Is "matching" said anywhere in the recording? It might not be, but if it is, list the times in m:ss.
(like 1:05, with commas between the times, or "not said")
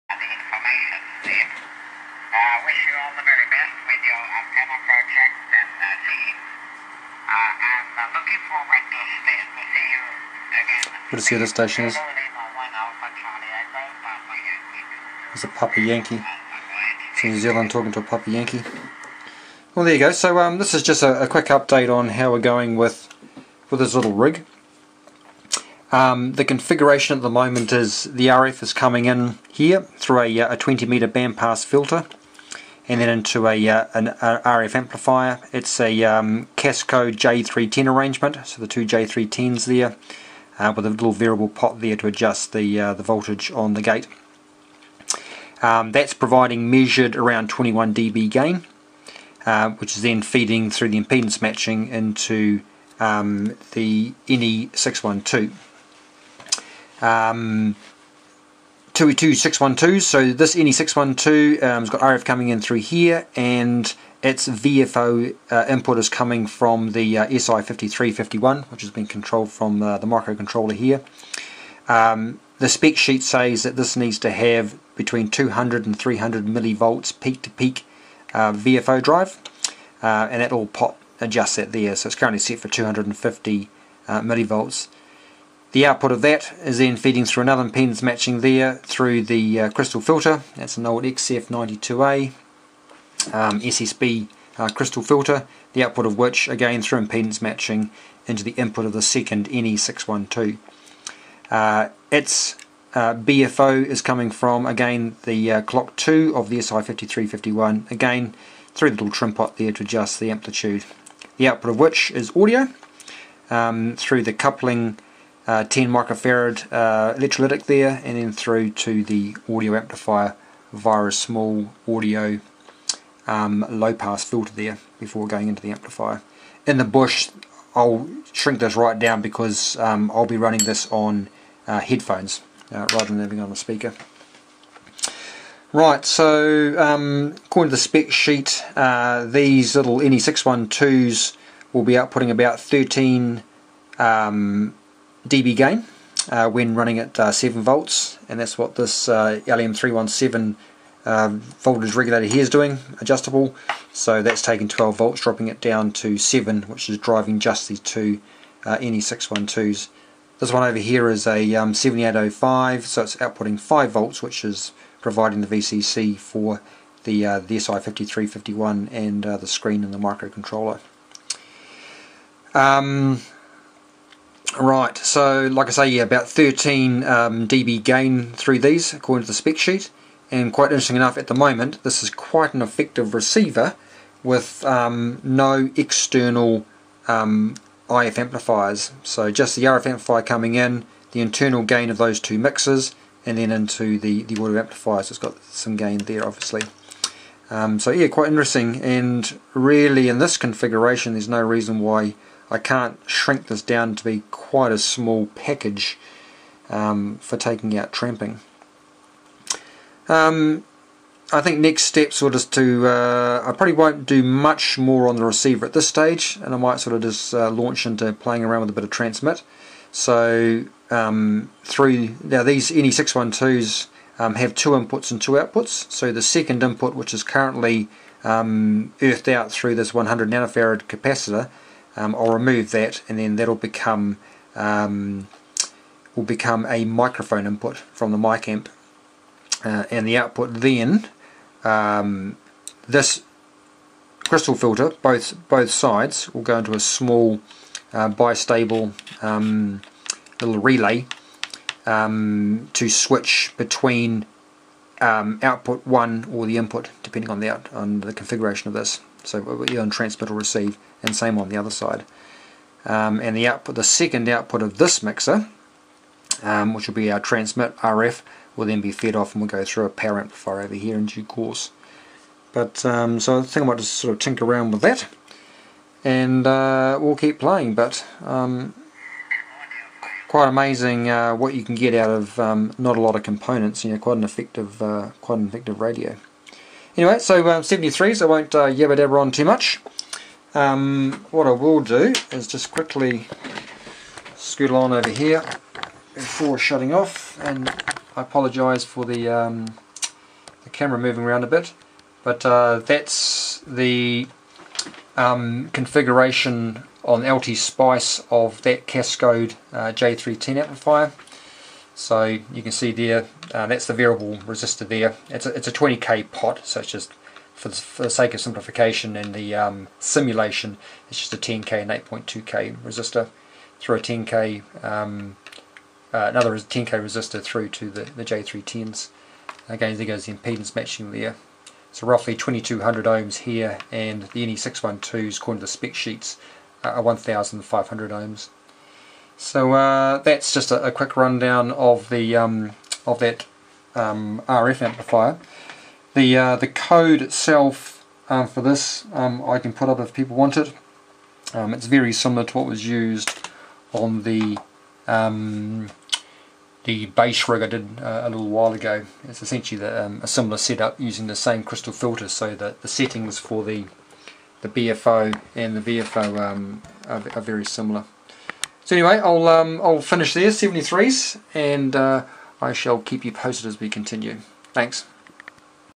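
0:51, 1:28, 1:37, 5:30.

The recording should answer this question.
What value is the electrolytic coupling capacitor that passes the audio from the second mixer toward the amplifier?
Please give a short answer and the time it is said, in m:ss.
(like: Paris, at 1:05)
10 microfarad, at 1:55.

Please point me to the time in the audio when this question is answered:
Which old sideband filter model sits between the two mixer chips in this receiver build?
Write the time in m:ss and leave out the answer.
1:31.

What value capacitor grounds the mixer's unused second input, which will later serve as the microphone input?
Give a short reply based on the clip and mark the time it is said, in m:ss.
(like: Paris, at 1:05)
100 nanofarad, at 3:49.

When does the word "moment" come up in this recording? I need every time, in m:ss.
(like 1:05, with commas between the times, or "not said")
0:27, 3:01.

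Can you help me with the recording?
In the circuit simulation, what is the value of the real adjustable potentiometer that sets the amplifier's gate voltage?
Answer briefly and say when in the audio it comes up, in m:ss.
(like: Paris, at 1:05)
20k, at 5:15.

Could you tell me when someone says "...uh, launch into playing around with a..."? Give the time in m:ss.
3:37.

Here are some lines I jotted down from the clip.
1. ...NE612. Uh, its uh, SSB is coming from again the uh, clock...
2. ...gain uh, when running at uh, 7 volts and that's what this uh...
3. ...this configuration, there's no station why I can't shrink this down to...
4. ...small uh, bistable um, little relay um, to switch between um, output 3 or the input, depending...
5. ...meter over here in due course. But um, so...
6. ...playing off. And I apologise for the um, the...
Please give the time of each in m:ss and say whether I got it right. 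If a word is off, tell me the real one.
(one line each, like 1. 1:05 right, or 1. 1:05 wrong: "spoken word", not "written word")
1. 1:39 wrong: "BFO", not "SSB"
2. 2:25 right
3. 3:20 wrong: "reason", not "station"
4. 4:06 wrong: "1", not "3"
5. 4:30 wrong: "amplifier", not "meter"
6. 4:56 wrong: "shutting", not "playing".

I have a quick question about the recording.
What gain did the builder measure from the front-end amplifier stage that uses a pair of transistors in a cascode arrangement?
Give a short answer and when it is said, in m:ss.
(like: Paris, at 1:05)
21 dB, at 0:47.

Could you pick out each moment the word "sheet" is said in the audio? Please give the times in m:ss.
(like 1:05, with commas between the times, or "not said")
1:12, 2:18, 2:59, 5:35.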